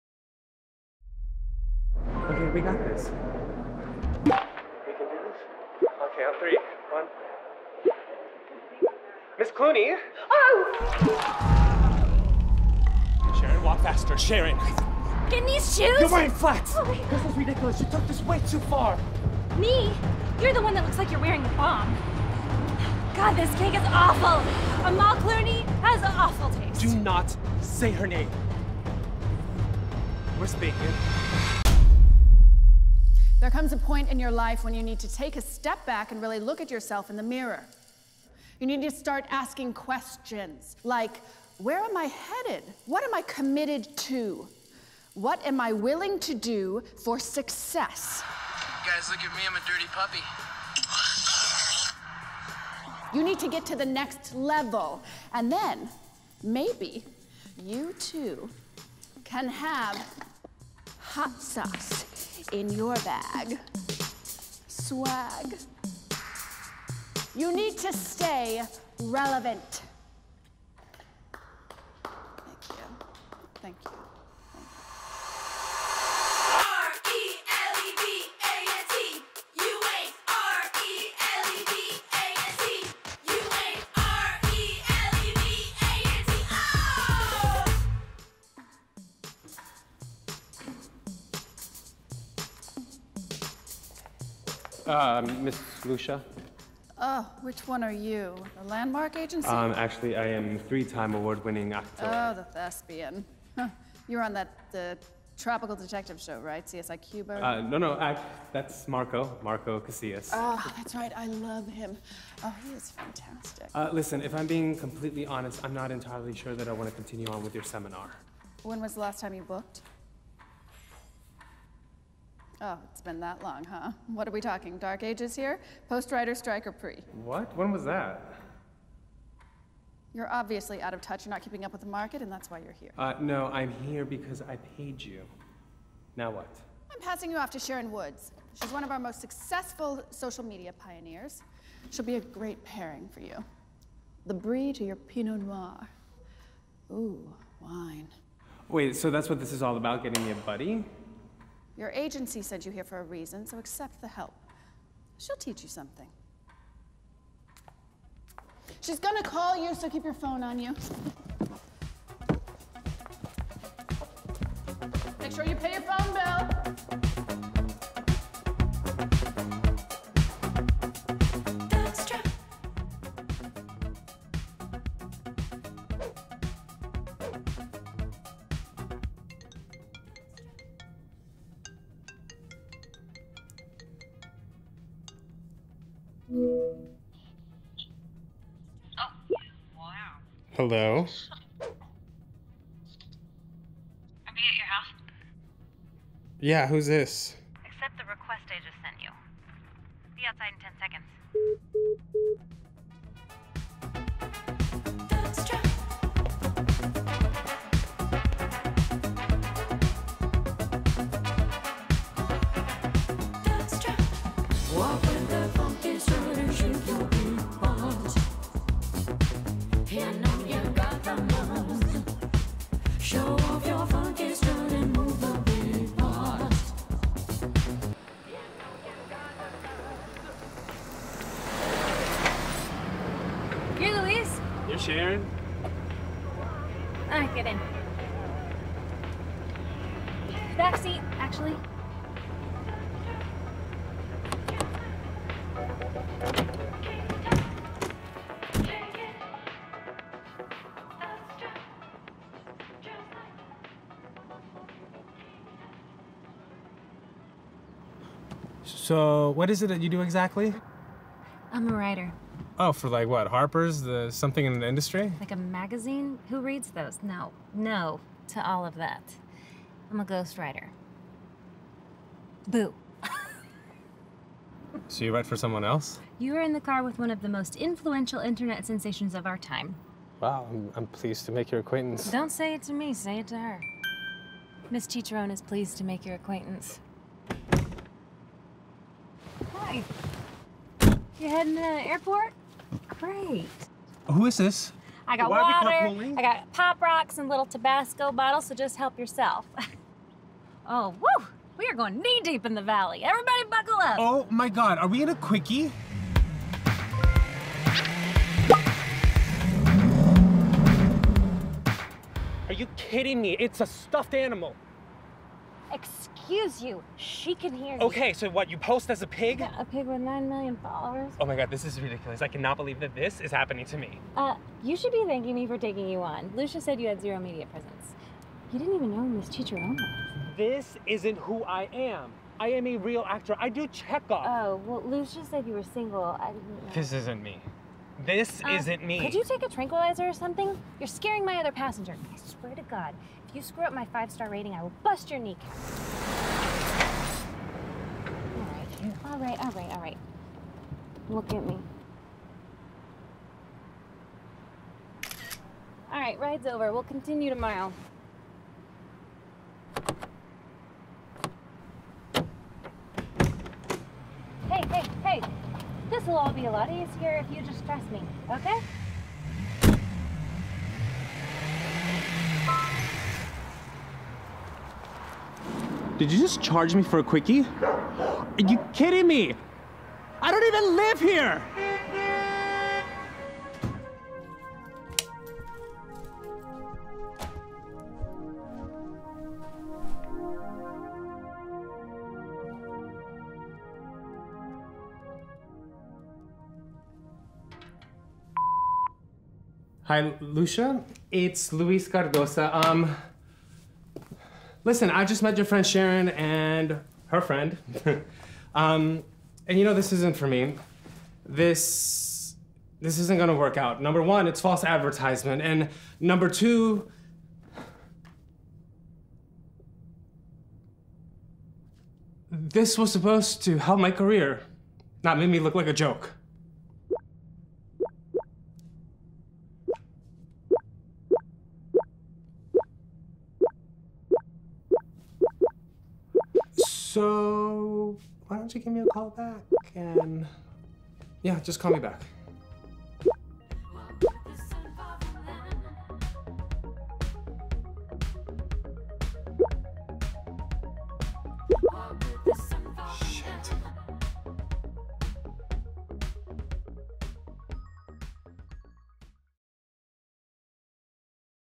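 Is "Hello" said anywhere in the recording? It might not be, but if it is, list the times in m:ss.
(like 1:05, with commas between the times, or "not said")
3:10.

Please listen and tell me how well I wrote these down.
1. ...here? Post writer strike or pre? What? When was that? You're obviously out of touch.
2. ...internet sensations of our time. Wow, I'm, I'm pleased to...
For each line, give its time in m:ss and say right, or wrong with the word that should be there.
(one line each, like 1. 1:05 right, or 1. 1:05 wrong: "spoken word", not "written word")
1. 2:05 right
2. 4:38 right.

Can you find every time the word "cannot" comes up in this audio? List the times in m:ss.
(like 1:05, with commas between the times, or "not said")
5:22.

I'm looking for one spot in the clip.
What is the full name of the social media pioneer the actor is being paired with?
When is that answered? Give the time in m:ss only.
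2:17.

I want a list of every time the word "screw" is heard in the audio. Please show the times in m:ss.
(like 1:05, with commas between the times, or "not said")
5:43.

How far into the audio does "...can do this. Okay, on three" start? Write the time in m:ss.
0:04.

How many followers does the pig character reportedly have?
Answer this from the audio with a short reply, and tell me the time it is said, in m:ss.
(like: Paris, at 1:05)
9 million, at 5:19.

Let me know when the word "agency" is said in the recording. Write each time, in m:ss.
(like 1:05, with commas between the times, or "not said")
1:39, 2:31.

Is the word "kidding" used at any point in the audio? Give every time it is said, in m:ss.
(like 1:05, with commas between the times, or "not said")
5:12, 6:18.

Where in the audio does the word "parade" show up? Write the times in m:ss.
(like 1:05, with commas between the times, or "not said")
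not said.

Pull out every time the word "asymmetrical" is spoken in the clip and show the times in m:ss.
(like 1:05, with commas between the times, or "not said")
not said.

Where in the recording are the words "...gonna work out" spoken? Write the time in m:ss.
6:53.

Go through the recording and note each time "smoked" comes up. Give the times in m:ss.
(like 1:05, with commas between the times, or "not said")
not said.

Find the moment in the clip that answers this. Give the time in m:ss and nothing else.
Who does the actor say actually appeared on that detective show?
1:49.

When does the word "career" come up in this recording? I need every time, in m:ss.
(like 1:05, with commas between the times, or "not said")
7:03.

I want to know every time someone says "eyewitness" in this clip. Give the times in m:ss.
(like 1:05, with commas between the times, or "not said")
not said.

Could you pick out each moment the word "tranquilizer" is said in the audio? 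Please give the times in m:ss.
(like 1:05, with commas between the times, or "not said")
5:39.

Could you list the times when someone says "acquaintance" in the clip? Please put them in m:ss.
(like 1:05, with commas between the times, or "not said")
4:41, 4:46.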